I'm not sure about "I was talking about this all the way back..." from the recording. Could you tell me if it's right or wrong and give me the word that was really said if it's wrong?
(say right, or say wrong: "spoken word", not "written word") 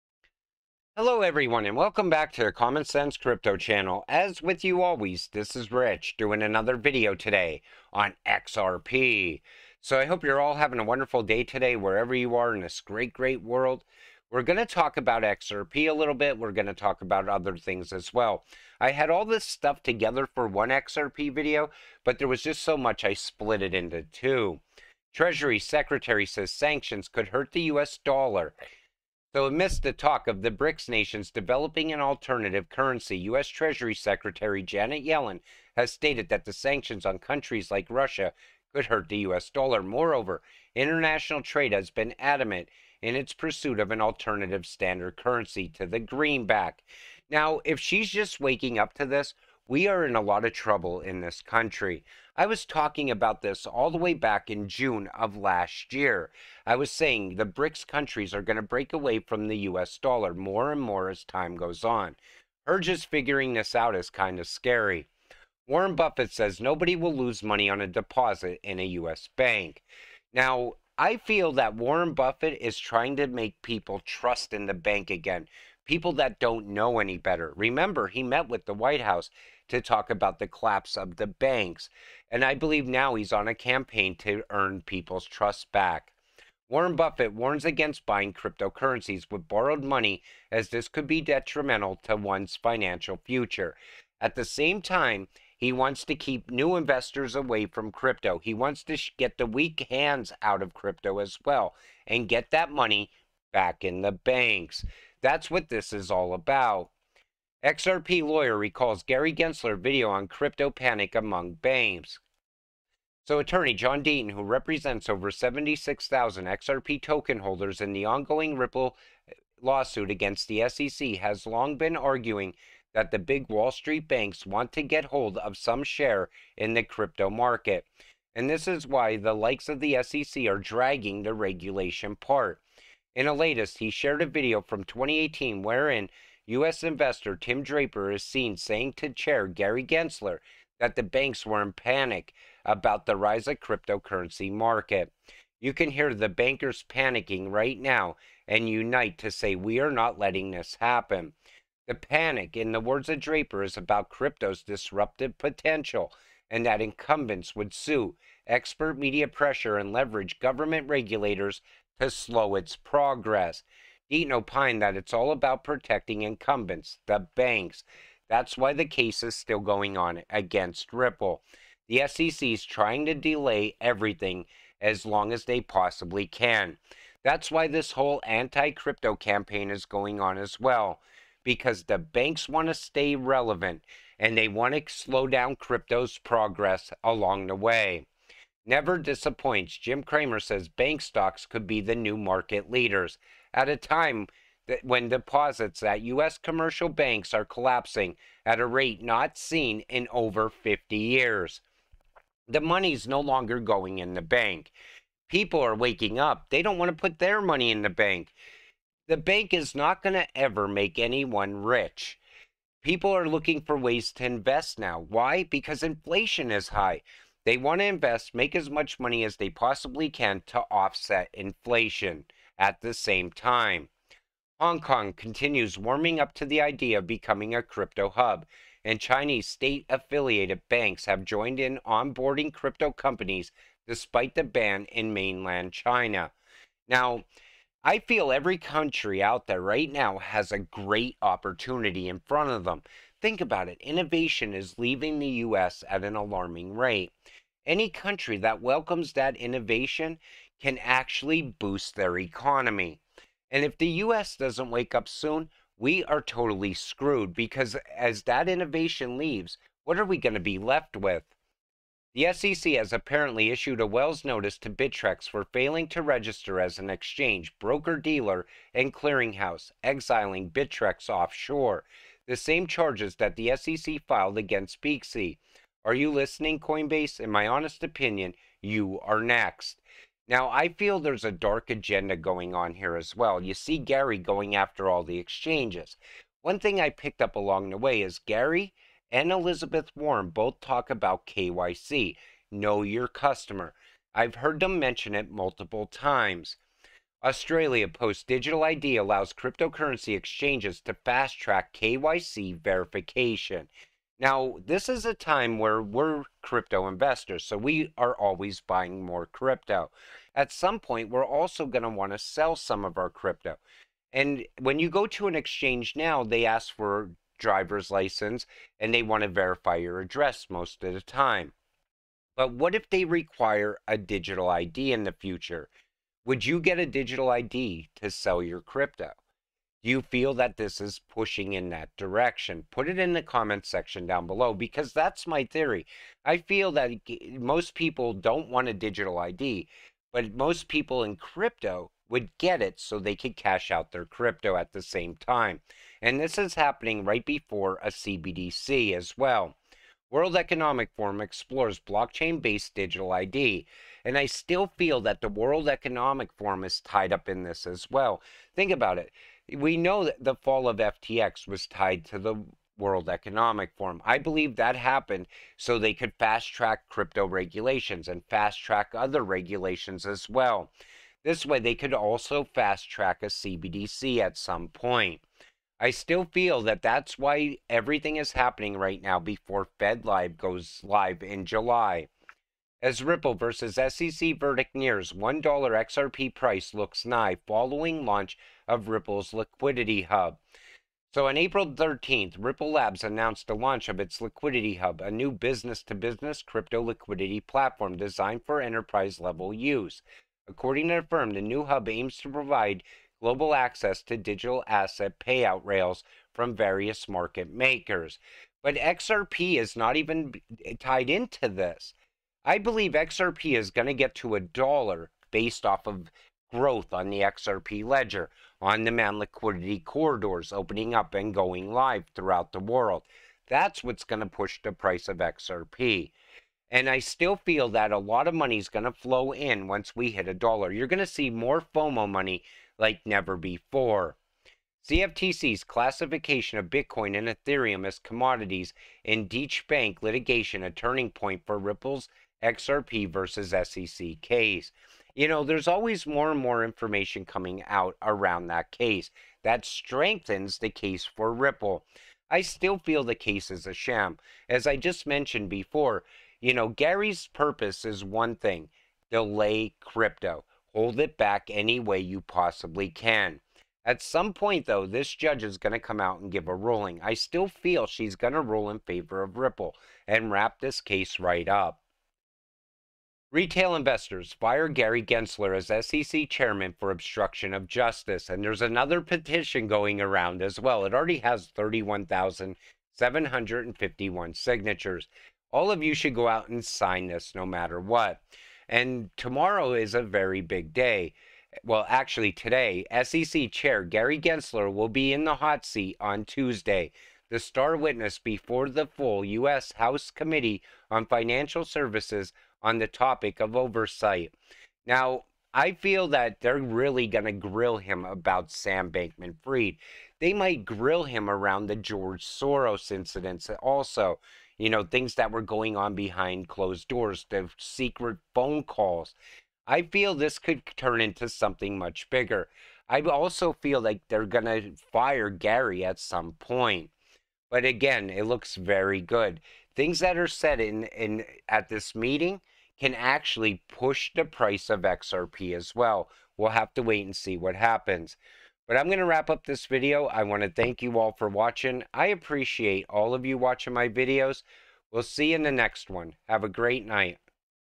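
right.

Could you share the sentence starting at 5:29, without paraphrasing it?
Do you feel that this is pushing in that direction?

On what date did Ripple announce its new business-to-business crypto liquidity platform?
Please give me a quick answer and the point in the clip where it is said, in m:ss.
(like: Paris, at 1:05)
April 13, at 6:31.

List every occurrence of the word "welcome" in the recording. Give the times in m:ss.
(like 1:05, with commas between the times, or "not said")
0:01, 4:08.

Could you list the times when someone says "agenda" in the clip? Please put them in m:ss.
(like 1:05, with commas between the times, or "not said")
4:41.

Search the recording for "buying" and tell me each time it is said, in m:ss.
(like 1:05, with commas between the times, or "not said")
1:28, 5:08.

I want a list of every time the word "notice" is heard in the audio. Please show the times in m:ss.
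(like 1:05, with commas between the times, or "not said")
4:24.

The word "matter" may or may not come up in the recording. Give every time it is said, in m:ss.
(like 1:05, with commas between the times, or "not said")
8:07.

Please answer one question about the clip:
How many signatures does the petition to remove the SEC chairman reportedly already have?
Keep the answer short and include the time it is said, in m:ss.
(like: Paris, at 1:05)
31,751, at 8:01.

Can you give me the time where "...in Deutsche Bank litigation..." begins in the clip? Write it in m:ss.
7:19.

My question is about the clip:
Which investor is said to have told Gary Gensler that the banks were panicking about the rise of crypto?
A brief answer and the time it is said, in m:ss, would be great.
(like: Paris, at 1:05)
Tim Draper, at 2:17.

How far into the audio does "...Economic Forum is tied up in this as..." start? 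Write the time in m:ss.
5:55.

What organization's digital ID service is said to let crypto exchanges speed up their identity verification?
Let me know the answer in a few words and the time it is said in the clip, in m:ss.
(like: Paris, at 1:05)
Australia Post, at 4:57.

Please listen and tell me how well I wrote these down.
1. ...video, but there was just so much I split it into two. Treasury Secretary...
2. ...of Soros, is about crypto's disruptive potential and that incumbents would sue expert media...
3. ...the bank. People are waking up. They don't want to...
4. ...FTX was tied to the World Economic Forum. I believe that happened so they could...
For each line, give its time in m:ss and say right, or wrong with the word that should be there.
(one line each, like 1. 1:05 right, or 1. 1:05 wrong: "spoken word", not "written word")
1. 0:21 right
2. 2:33 wrong: "Draper", not "Soros"
3. 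3:24 right
4. 6:00 right.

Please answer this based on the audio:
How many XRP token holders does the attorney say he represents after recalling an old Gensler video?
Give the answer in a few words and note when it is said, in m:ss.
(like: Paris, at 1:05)
76,000, at 1:55.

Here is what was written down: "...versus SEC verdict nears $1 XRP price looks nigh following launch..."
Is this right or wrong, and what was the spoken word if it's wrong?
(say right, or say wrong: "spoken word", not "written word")
right.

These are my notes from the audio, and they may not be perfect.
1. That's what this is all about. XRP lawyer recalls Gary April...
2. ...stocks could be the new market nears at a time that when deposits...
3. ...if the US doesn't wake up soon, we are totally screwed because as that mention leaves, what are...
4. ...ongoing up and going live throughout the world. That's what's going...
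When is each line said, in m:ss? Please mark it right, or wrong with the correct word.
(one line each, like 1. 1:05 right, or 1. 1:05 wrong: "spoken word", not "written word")
1. 1:45 wrong: "Gensler", not "April"
2. 3:11 wrong: "leaders", not "nears"
3. 4:13 wrong: "innovation", not "mention"
4. 7:00 wrong: "opening", not "ongoing".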